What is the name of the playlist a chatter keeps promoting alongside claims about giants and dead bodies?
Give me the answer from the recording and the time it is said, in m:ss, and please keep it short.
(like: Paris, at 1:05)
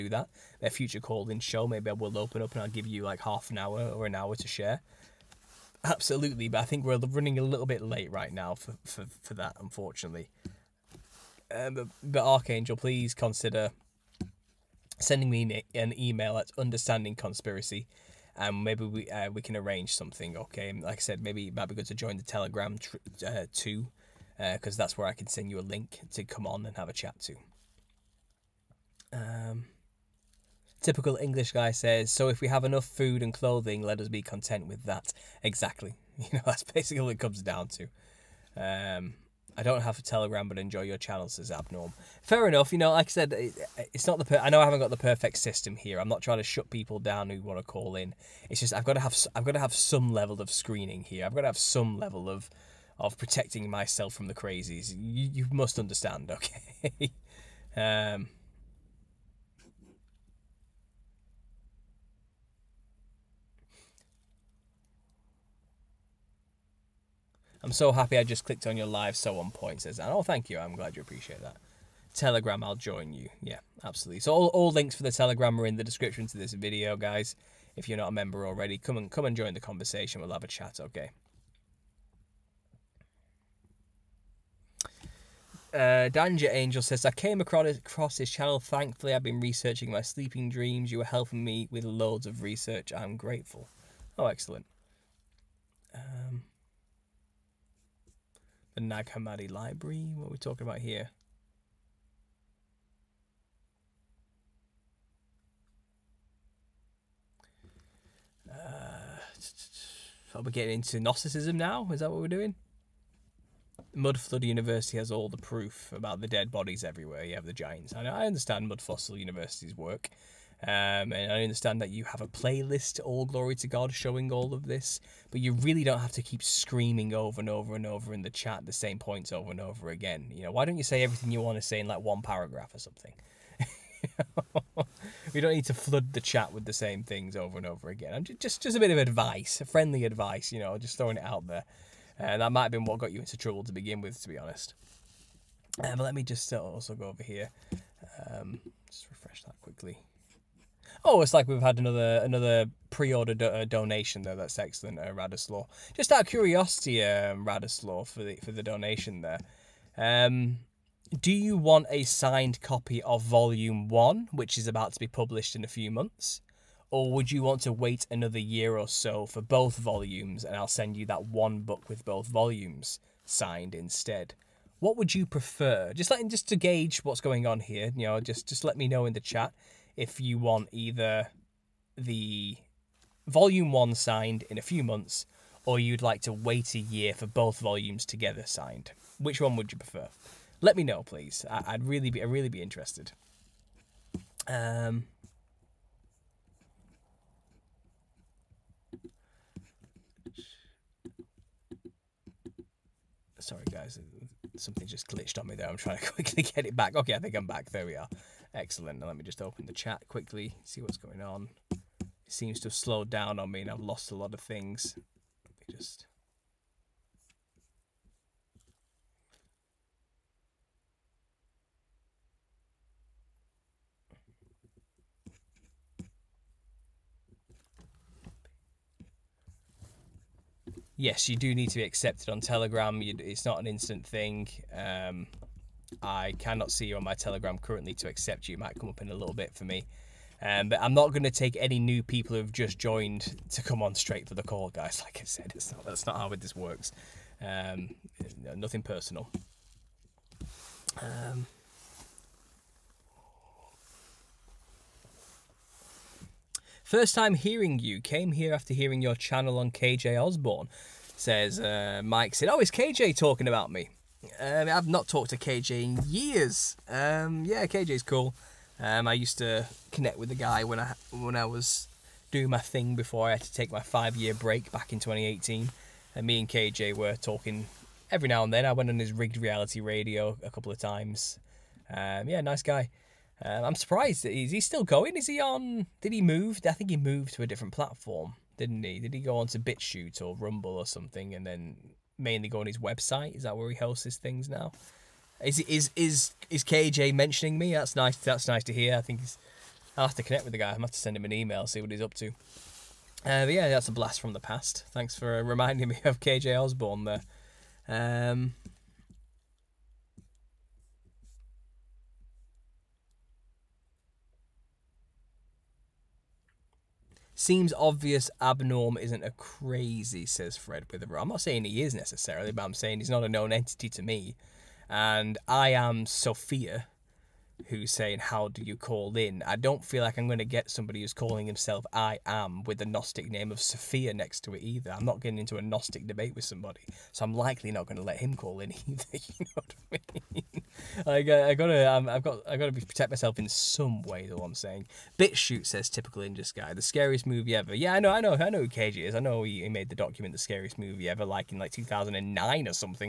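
All Glory to God, at 2:03.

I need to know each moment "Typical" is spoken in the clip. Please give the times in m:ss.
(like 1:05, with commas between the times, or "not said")
0:30, 5:45.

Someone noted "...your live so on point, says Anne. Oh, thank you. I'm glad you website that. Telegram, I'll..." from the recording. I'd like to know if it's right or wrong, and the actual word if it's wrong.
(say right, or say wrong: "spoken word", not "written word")
wrong: "appreciate", not "website".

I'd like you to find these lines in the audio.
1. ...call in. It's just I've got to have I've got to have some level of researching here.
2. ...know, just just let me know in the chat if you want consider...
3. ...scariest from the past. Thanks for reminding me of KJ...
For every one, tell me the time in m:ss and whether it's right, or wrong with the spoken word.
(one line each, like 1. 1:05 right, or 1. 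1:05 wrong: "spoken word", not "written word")
1. 0:47 wrong: "screening", not "researching"
2. 2:58 wrong: "either", not "consider"
3. 5:03 wrong: "blast", not "scariest".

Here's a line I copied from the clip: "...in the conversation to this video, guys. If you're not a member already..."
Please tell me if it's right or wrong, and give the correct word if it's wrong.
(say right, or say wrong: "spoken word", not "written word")
wrong: "description", not "conversation".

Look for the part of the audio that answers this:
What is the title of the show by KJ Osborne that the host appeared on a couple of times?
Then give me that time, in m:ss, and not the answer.
4:39.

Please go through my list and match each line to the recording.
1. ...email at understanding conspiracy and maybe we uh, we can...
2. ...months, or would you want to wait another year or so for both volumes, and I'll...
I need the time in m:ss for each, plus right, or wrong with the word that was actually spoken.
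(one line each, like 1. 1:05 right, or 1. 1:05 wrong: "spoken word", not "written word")
1. 0:15 right
2. 2:45 right.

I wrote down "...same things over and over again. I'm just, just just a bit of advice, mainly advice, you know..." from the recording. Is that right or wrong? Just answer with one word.
wrong.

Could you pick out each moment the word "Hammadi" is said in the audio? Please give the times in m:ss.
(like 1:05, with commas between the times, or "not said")
1:39.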